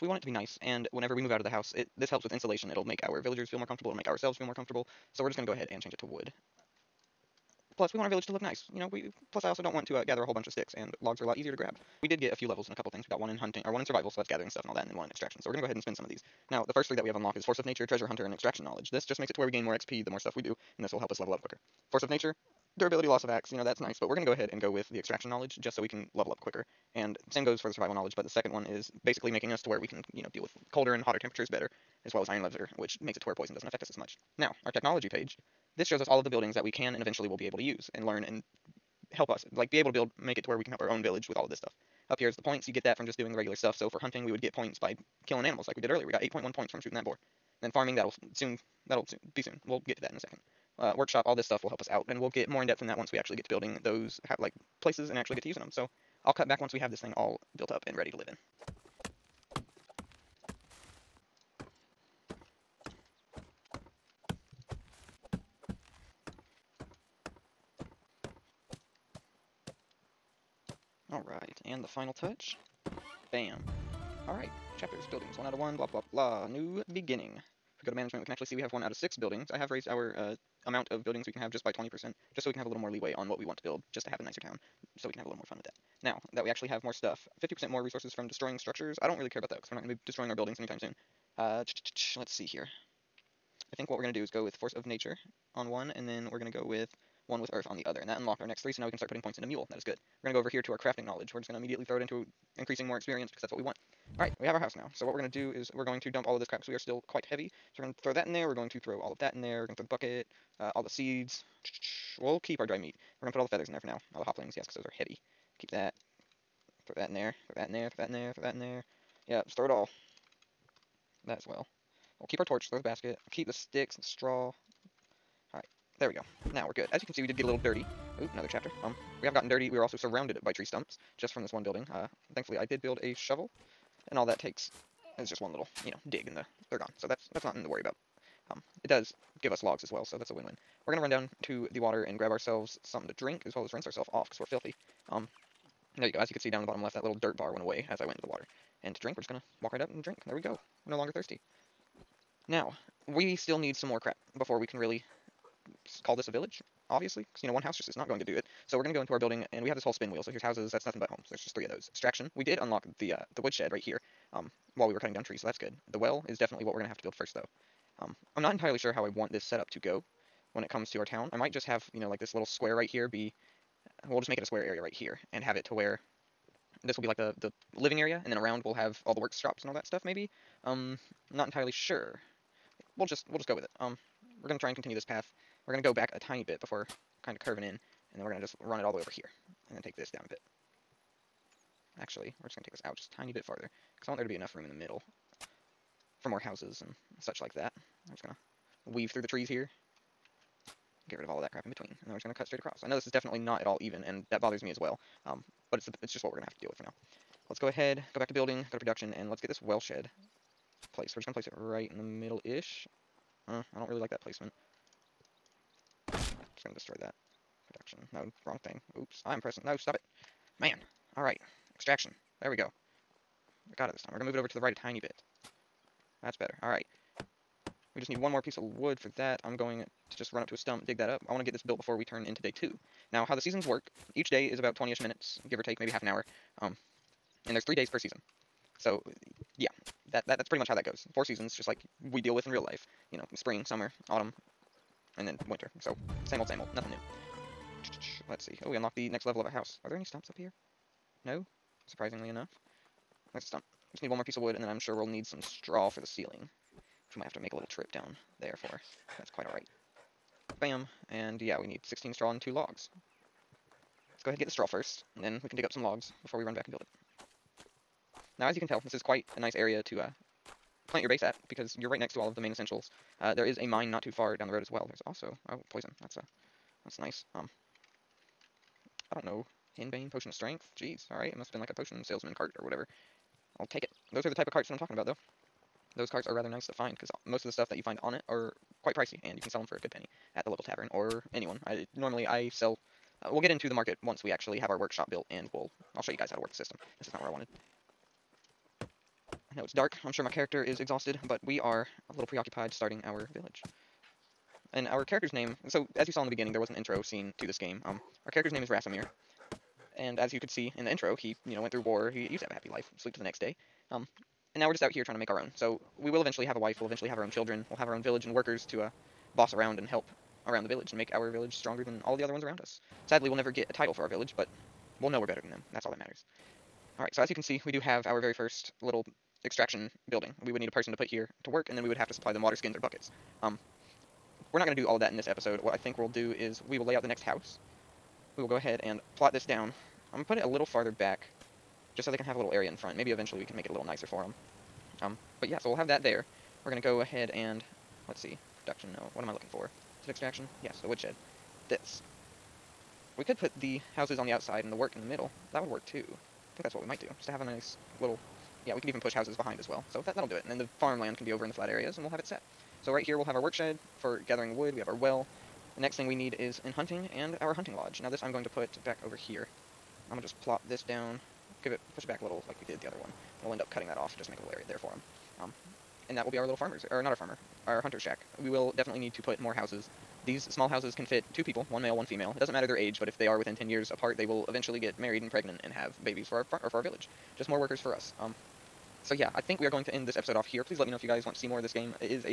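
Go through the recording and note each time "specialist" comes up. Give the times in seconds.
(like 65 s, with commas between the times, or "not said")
not said.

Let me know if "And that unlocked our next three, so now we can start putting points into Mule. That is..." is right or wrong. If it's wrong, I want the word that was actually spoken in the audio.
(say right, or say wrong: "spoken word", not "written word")
right.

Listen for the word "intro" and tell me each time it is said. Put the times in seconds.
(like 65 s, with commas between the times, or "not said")
306 s, 310 s.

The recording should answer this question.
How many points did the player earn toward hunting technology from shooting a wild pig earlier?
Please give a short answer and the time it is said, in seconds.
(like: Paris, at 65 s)
8.1, at 46 s.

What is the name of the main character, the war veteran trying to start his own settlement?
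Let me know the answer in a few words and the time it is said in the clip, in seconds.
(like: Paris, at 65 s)
Racimir, at 308 s.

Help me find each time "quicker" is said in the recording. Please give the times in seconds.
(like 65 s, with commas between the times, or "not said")
21 s, 26 s.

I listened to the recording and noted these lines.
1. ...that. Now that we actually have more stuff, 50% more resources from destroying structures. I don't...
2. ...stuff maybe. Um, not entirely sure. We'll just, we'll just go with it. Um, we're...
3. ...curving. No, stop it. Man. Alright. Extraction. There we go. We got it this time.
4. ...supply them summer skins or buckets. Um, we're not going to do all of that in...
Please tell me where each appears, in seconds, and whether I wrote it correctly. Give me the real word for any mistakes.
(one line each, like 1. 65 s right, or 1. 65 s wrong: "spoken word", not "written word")
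1. 85 s right
2. 179 s right
3. 219 s wrong: "pressing", not "curving"
4. 332 s wrong: "water", not "summer".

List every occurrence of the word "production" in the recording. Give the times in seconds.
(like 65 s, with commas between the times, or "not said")
208 s, 217 s.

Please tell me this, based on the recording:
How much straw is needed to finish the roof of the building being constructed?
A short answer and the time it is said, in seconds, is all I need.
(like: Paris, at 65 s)
16, at 261 s.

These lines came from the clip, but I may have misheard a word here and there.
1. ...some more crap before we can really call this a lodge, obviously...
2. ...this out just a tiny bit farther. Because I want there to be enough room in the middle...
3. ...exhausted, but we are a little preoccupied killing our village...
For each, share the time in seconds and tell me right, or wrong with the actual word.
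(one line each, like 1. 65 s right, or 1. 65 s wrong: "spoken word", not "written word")
1. 153 s wrong: "village", not "lodge"
2. 192 s right
3. 300 s wrong: "starting", not "killing".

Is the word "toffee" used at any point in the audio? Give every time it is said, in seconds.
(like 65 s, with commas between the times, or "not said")
not said.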